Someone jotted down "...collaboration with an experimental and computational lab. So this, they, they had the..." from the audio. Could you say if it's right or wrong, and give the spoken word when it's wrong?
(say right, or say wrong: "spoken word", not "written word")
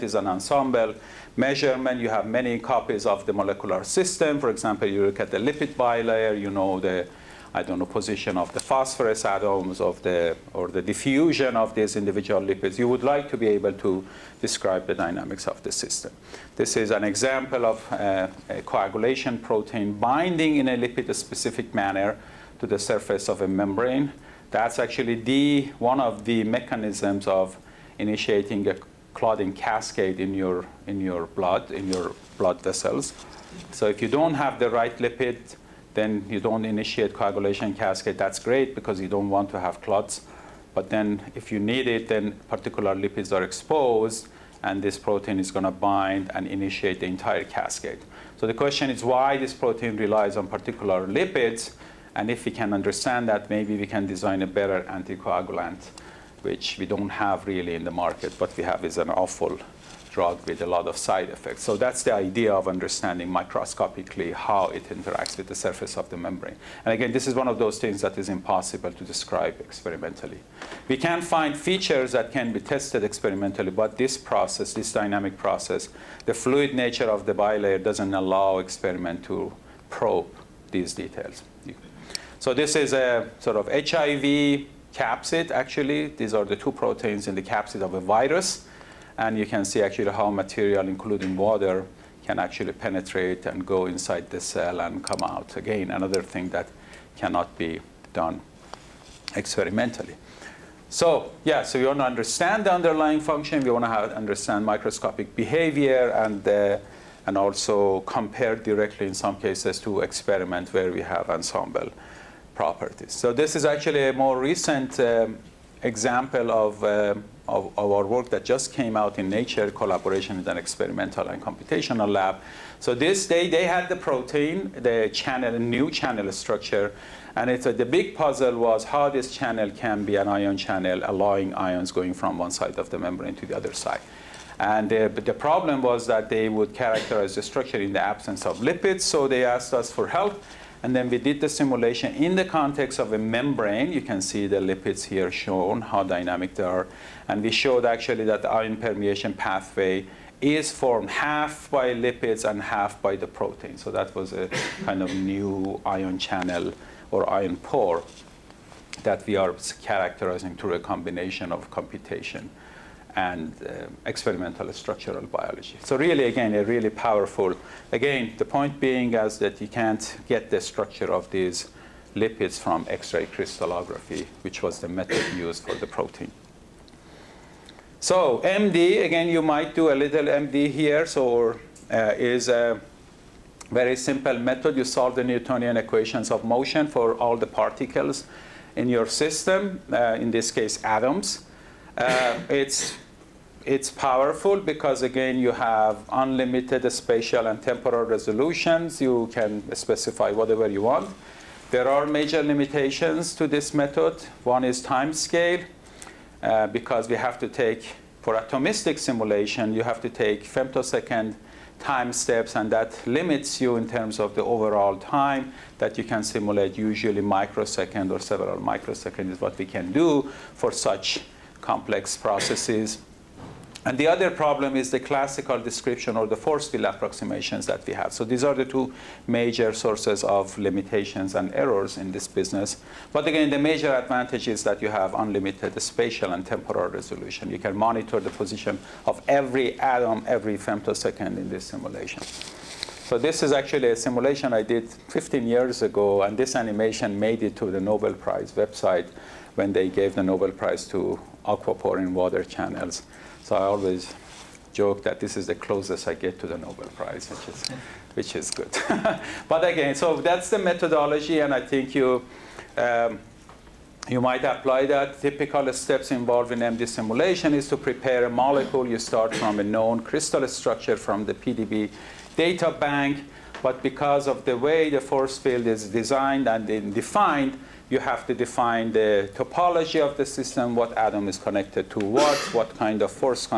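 right.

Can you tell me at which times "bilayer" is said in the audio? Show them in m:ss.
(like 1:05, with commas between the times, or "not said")
0:05, 1:17.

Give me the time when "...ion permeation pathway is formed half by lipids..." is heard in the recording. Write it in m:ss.
2:28.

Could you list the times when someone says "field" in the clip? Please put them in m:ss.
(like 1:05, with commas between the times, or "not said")
3:46, 4:35.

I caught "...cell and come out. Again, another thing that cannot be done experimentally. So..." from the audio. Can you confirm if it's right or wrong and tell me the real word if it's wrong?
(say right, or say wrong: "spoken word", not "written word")
right.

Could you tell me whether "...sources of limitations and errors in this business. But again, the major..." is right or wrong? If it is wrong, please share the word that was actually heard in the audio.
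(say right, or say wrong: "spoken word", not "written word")
right.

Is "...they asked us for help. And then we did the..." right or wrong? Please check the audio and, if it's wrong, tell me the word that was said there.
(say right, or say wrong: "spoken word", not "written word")
right.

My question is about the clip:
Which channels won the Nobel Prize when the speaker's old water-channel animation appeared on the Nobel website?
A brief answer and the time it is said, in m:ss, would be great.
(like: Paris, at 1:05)
Aquaporin water channels, at 4:11.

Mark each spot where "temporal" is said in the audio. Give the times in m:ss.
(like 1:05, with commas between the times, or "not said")
3:17, 3:56.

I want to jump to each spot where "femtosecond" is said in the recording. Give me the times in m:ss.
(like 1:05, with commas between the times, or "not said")
3:30, 4:00.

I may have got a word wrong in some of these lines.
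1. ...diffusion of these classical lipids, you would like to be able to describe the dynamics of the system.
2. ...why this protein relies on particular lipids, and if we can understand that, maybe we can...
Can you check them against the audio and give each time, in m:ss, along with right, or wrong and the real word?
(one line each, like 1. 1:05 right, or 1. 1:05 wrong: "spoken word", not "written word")
1. 0:10 wrong: "individual", not "classical"
2. 0:49 right.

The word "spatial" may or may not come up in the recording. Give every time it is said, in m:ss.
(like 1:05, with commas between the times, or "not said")
3:16, 3:55.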